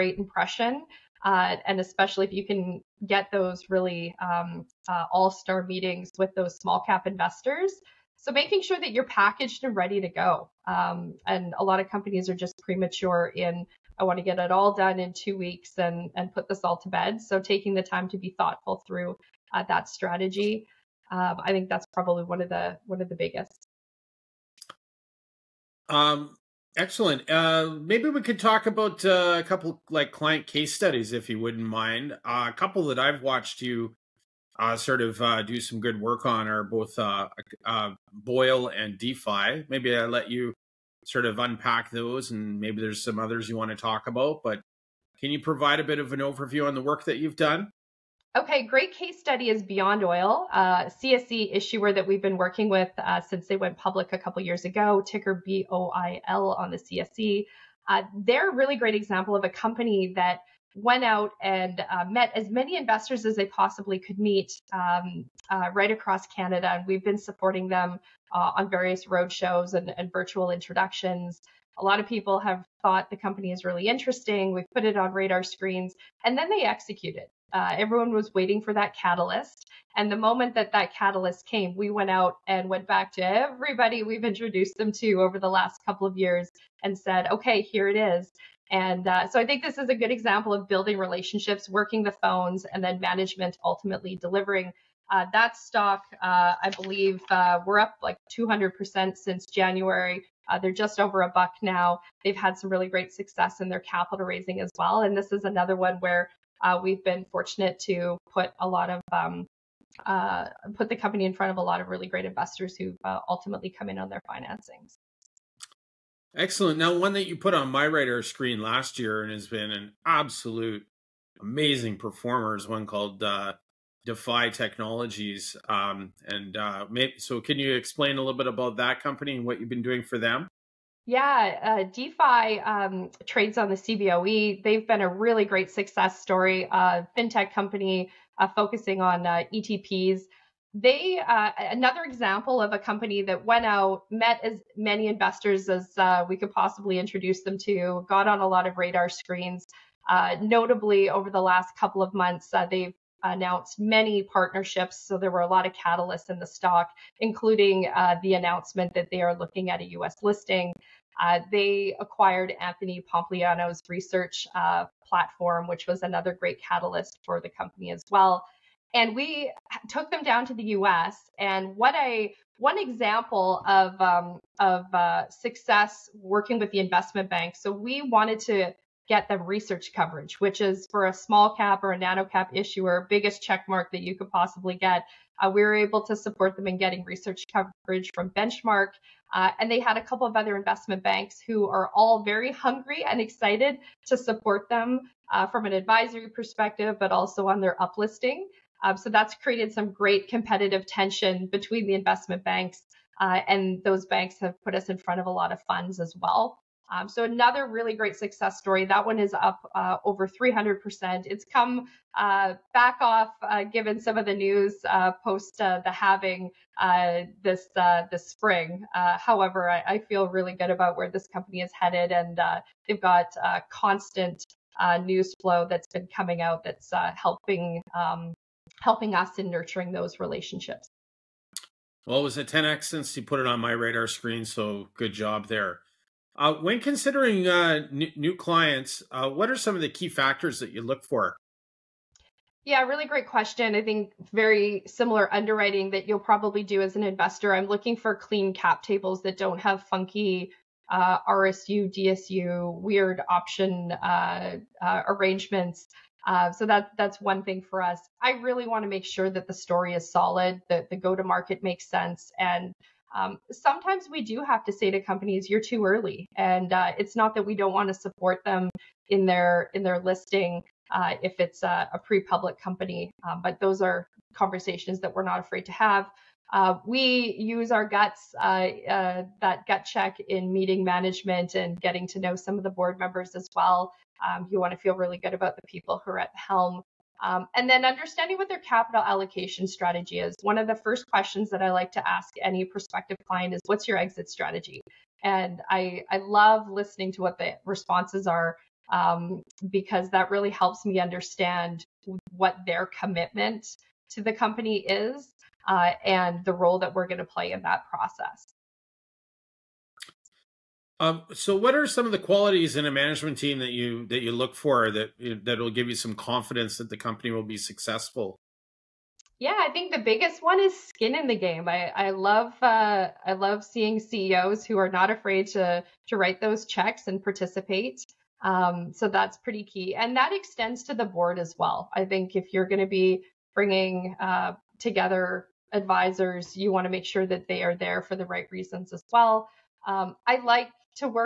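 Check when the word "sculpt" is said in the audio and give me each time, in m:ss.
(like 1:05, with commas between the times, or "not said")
not said.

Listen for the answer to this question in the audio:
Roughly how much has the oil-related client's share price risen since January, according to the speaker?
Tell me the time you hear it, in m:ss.
1:38.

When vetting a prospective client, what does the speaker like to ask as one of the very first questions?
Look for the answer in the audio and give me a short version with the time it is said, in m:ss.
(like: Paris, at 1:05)
What's your exit strategy?, at 4:53.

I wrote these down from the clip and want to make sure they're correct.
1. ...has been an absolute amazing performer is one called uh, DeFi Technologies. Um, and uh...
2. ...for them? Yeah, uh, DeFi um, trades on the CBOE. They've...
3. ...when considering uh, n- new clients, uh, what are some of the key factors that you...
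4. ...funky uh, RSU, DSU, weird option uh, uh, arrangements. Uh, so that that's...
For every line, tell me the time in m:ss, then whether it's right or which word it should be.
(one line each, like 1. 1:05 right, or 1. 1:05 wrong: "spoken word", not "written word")
1. 1:59 right
2. 2:10 right
3. 3:56 right
4. 4:09 right.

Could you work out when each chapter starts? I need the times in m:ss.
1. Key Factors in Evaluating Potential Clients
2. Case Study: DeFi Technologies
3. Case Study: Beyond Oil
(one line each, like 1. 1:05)
1. 4:02
2. 2:10
3. 0:47.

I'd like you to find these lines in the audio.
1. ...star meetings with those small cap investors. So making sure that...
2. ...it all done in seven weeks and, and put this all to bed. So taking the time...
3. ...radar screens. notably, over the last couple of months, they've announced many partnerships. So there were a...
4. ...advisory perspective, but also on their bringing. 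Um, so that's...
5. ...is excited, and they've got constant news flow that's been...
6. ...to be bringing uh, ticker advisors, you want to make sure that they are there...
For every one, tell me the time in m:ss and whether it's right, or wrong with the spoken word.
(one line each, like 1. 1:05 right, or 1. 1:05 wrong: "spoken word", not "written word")
1. 0:05 right
2. 0:14 wrong: "two", not "seven"
3. 2:28 right
4. 3:15 wrong: "uplisting", not "bringing"
5. 3:41 wrong: "headed", not "excited"
6. 5:32 wrong: "together", not "ticker".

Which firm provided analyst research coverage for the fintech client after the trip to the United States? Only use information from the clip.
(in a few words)
Benchmark.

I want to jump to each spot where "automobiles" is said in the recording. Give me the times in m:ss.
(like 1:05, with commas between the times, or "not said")
not said.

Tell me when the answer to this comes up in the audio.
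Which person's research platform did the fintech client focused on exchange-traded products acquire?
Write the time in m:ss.
2:42.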